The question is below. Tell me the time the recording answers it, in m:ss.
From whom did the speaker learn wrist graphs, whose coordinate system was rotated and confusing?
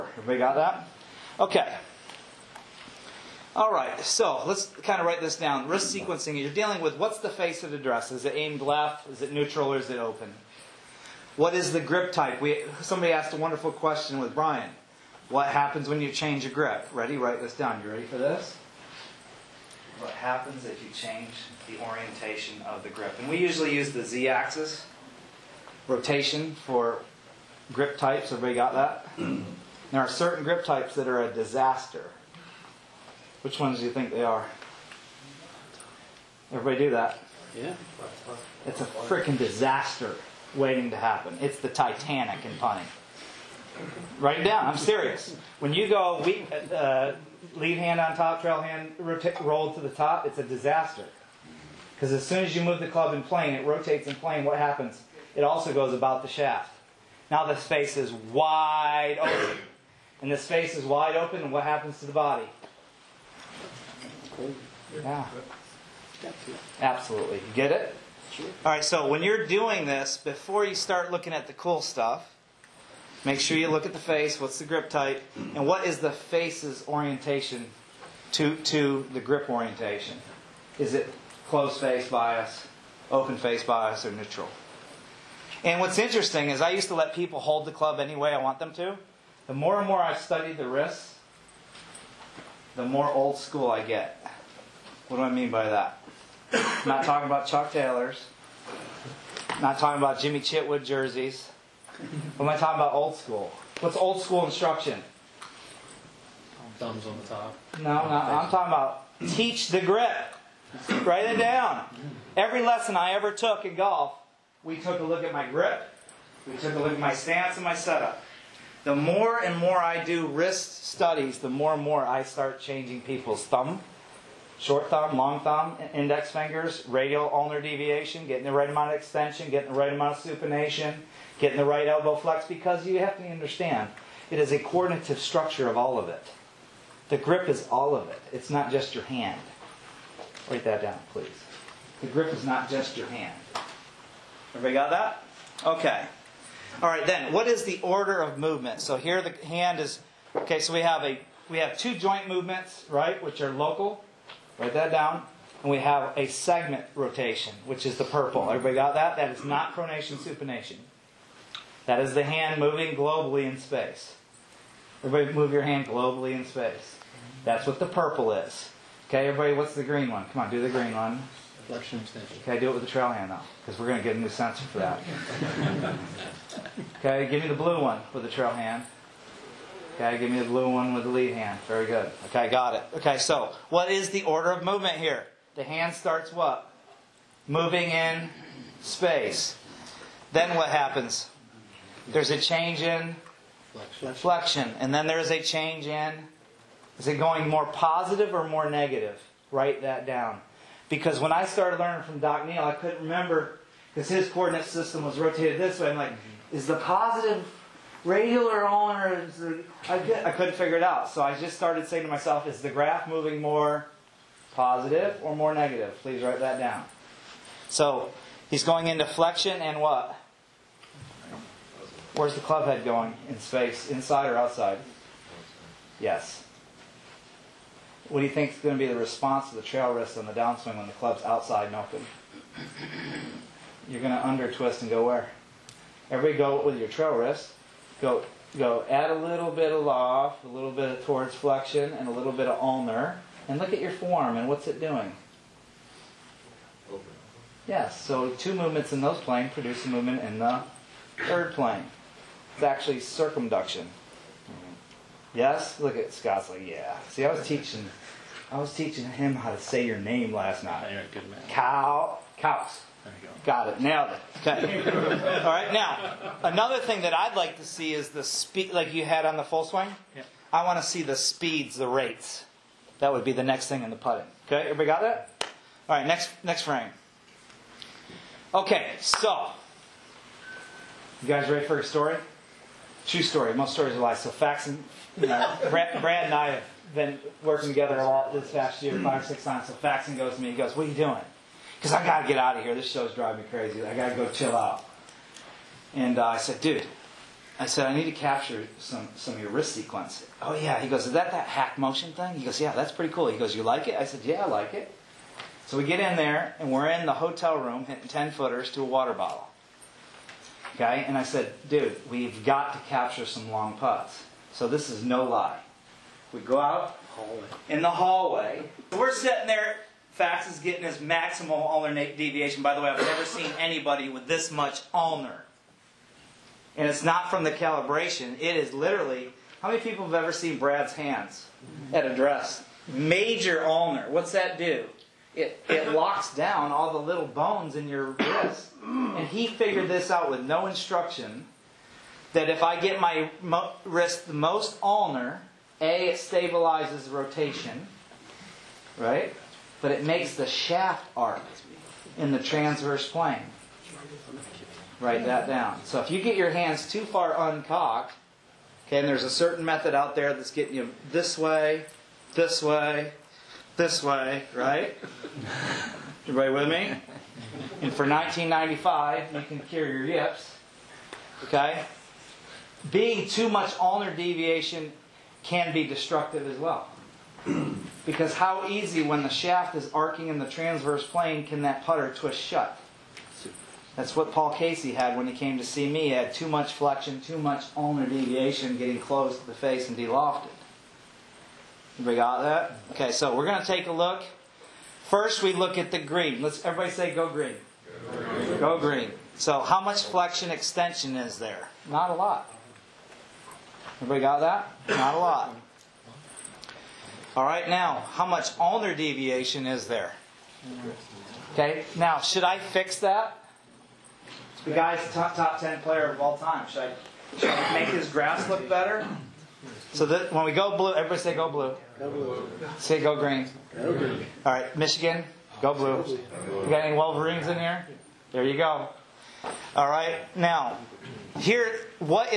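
3:22.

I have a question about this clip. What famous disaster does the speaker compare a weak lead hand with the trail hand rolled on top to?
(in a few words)
The Titanic.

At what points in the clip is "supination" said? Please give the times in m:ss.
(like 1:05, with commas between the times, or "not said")
2:10, 2:40.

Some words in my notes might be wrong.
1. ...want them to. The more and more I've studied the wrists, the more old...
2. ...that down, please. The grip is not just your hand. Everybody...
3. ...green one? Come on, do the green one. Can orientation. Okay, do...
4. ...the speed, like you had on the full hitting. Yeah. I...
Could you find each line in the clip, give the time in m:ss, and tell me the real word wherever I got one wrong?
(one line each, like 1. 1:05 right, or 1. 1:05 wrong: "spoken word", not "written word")
1. 1:28 right
2. 2:20 right
3. 2:49 wrong: "extension", not "orientation"
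4. 4:28 wrong: "swing", not "hitting".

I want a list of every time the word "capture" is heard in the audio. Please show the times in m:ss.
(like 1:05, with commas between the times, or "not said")
4:58, 5:12.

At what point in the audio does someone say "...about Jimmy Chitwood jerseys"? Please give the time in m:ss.
1:40.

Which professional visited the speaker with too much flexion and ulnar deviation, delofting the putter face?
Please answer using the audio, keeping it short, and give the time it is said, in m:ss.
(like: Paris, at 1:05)
Paul Casey, at 6:24.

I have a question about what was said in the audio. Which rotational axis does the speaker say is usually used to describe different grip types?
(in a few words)
Z axis.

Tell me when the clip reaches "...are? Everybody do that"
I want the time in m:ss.
0:34.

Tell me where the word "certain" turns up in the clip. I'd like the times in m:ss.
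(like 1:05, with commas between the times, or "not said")
0:30, 5:59.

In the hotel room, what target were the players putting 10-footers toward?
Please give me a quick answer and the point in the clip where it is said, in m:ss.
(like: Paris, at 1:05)
A water bottle, at 5:08.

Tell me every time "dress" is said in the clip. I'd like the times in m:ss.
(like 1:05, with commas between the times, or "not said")
0:07, 5:32.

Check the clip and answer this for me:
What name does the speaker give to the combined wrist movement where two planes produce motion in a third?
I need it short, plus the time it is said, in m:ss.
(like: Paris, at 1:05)
Circumduction, at 4:12.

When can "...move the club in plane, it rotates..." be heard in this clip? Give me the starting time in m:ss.
0:52.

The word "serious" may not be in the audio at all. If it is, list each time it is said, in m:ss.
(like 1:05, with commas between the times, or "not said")
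0:44.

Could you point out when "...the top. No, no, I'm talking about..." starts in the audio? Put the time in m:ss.
1:47.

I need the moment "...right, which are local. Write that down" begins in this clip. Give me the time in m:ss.
2:32.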